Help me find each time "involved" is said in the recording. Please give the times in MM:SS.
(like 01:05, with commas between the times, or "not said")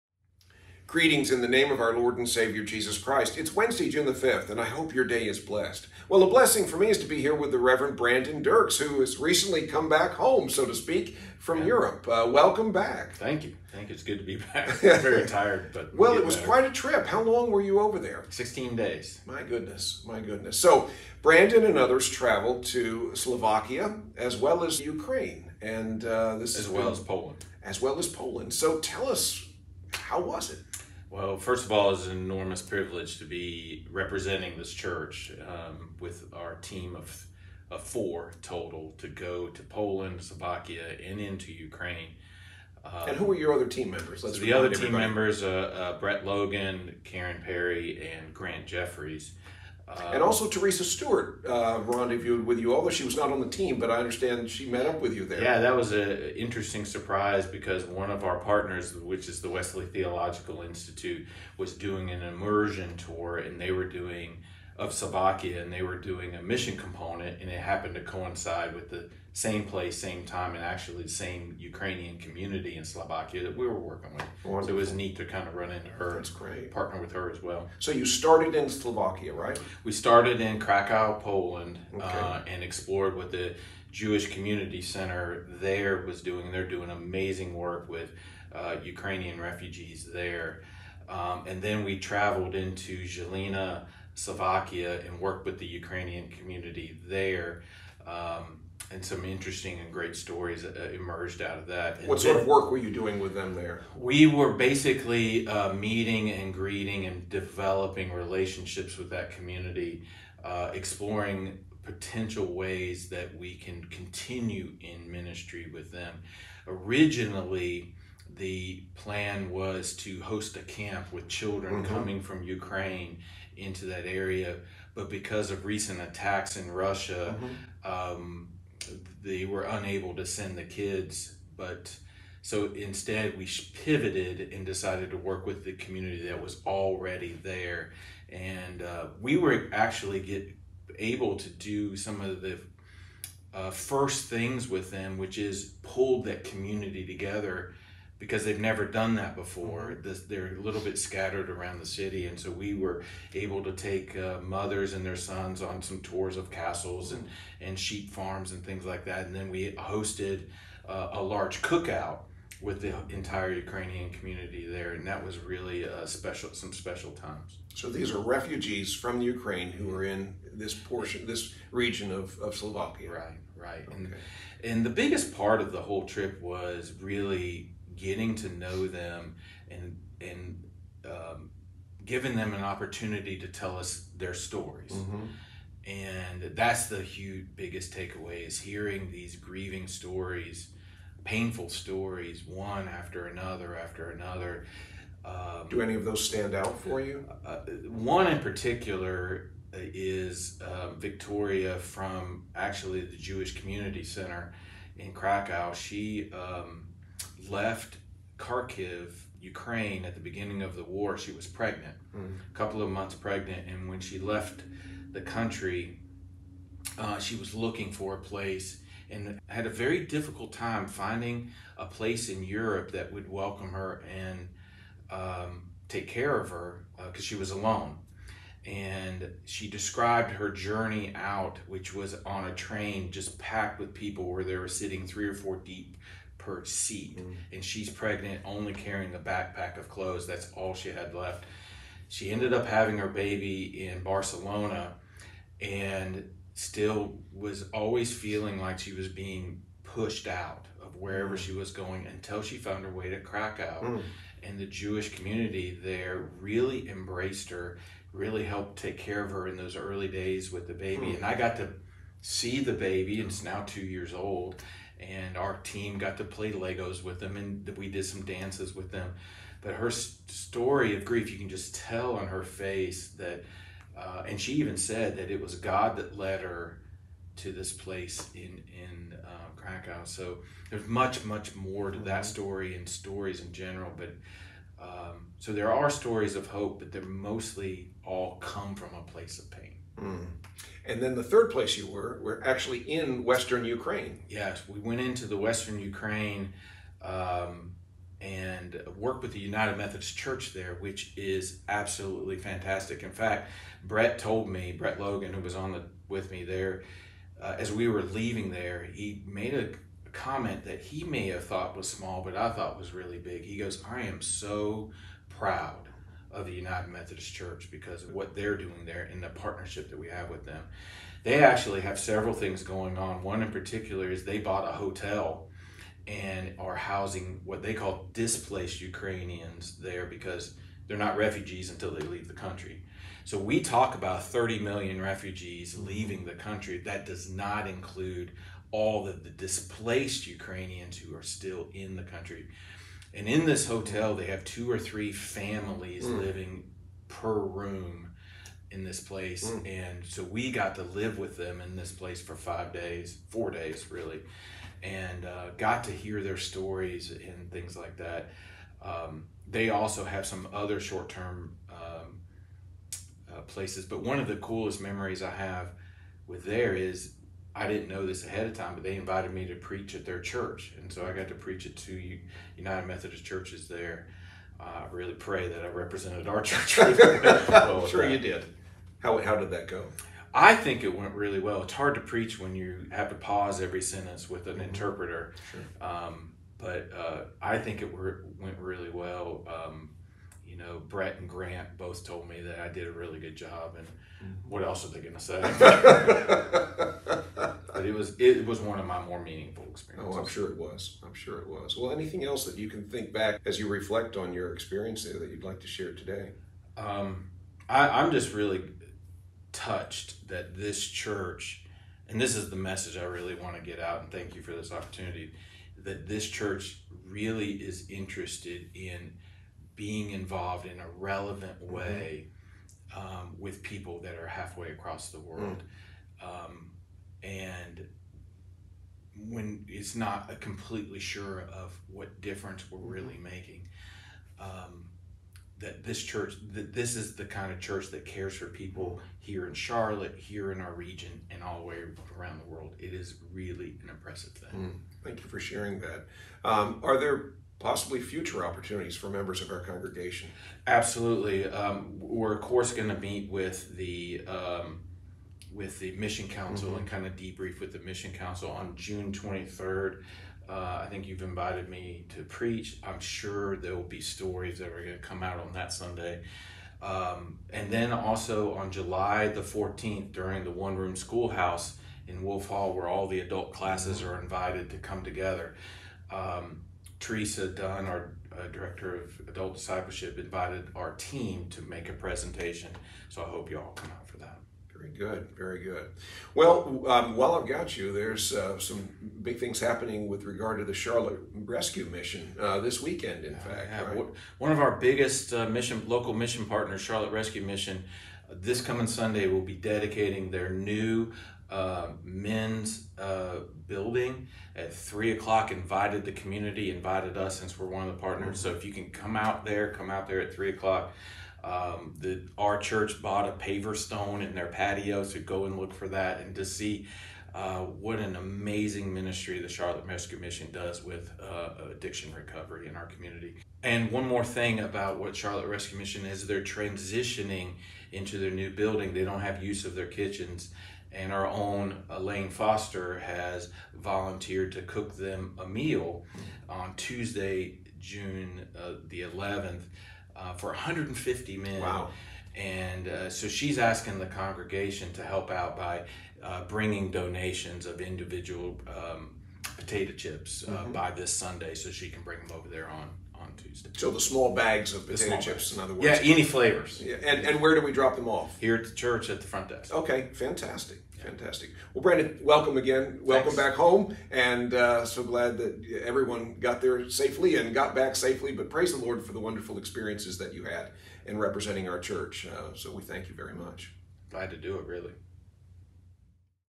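07:00.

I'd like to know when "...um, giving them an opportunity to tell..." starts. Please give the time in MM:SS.
03:01.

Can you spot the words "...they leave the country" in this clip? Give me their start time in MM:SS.
05:31.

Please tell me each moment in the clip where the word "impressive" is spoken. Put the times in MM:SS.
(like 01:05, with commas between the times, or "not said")
07:23.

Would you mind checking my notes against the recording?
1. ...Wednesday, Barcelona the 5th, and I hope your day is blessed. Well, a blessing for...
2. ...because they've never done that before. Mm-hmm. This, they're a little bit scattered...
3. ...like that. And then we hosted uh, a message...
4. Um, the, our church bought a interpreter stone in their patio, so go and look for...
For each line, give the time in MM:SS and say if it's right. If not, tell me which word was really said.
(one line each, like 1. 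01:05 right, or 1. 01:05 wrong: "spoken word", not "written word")
1. 00:03 wrong: "June", not "Barcelona"
2. 02:28 right
3. 02:38 wrong: "large", not "message"
4. 08:31 wrong: "paver", not "interpreter".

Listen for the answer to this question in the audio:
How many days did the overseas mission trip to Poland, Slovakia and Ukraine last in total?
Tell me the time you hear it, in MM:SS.
00:18.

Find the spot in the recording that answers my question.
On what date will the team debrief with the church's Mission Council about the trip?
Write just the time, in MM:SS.
07:38.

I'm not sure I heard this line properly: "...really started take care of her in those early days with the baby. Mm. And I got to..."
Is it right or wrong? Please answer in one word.
wrong.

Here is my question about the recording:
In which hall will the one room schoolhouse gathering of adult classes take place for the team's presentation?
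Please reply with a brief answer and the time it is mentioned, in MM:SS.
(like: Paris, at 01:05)
Wolf Hall, at 07:52.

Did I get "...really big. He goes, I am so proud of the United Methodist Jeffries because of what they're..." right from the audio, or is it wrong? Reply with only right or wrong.
wrong.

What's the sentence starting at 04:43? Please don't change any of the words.
But um, so there are stories of hope, but they're mostly all come from a place of pain.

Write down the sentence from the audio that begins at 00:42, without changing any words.
Um, and who were your other team members?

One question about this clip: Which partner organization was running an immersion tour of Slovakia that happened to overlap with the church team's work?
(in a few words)
Wesley Theological Institute.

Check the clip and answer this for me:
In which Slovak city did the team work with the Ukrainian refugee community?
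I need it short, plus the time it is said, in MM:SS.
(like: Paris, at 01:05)
Žilina, at 01:33.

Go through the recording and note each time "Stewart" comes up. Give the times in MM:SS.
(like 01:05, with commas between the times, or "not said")
00:50.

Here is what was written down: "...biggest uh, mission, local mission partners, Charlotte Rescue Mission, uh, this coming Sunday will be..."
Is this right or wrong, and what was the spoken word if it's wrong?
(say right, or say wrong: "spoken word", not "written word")
right.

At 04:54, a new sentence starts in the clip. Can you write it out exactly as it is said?
Yes, we went into the Western Ukraine um, and worked with the United Methodist Church there, which is absolutely fantastic.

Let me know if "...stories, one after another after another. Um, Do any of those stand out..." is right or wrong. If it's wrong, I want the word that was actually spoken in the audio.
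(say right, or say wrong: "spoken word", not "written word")
right.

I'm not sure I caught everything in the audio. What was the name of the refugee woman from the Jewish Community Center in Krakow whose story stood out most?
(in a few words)
Victoria.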